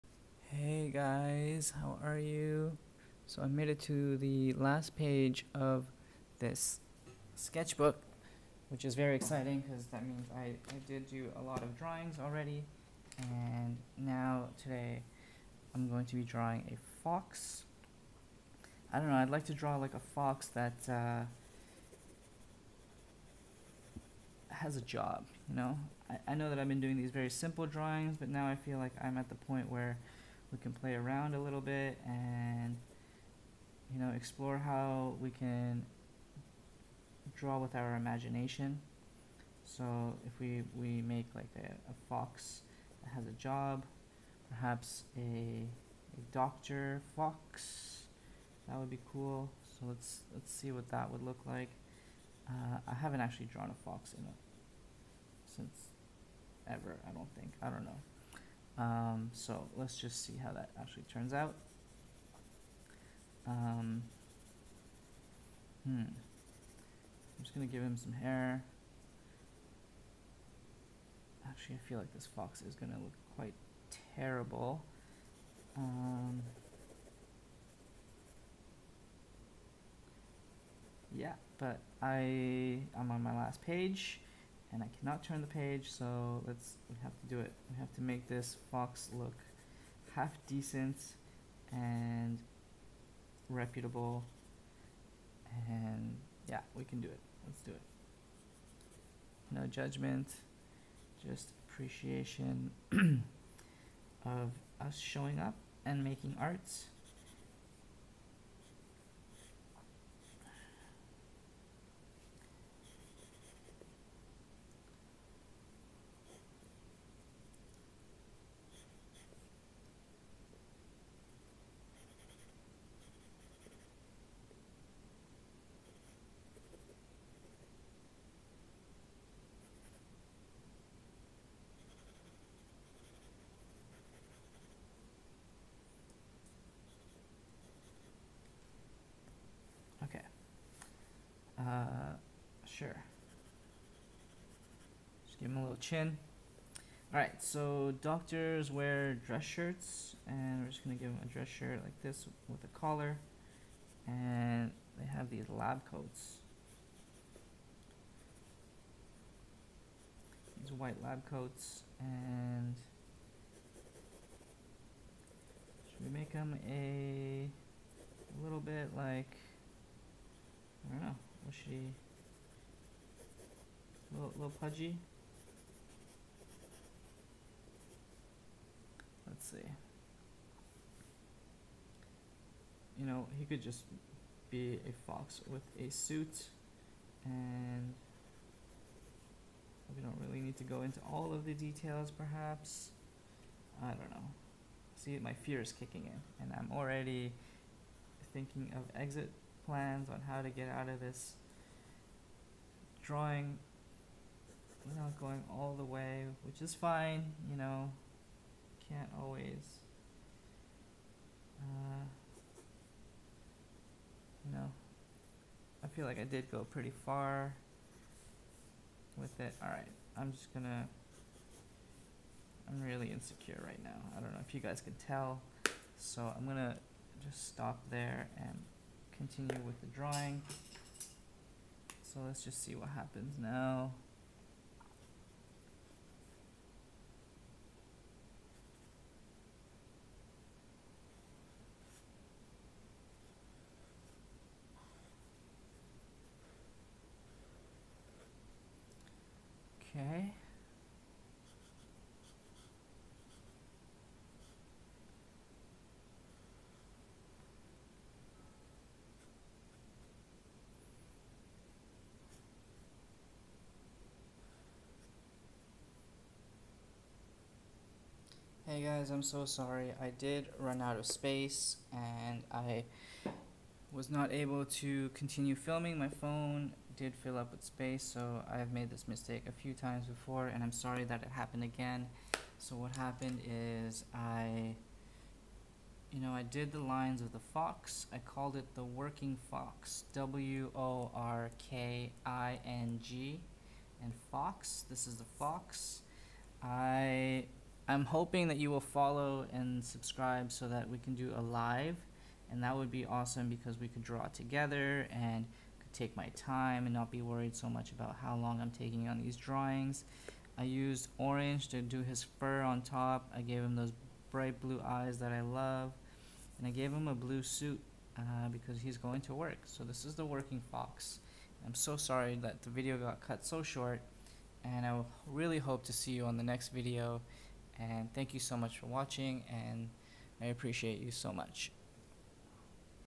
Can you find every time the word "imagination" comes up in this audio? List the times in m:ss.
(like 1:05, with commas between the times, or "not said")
0:37.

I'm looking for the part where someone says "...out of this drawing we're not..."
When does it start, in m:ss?
3:20.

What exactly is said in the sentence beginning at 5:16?
And I gave him a blue suit uh, because he's going to work.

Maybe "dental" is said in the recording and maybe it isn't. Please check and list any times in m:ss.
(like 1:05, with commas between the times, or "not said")
not said.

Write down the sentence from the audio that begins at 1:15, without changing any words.
Um, yeah, but I, I'm on my last page and I cannot turn the page, so let's we have to do it.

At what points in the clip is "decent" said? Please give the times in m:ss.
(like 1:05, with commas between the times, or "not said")
1:30.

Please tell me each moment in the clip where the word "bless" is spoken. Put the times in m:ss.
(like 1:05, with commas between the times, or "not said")
not said.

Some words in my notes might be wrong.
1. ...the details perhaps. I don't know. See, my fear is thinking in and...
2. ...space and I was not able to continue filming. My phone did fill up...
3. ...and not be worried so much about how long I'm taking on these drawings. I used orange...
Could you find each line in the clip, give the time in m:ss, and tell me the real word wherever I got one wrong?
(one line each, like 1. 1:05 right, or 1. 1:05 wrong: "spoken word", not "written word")
1. 3:11 wrong: "kicking", not "thinking"
2. 4:31 right
3. 5:06 right.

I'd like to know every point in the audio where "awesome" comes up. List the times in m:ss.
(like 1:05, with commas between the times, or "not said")
5:03.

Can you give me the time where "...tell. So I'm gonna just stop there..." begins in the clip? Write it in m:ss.
3:45.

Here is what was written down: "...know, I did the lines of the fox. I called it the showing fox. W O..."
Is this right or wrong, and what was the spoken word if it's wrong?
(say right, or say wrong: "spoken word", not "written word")
wrong: "working", not "showing".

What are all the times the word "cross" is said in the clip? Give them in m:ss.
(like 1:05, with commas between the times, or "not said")
not said.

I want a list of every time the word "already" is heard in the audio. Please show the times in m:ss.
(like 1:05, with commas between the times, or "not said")
0:12, 3:16.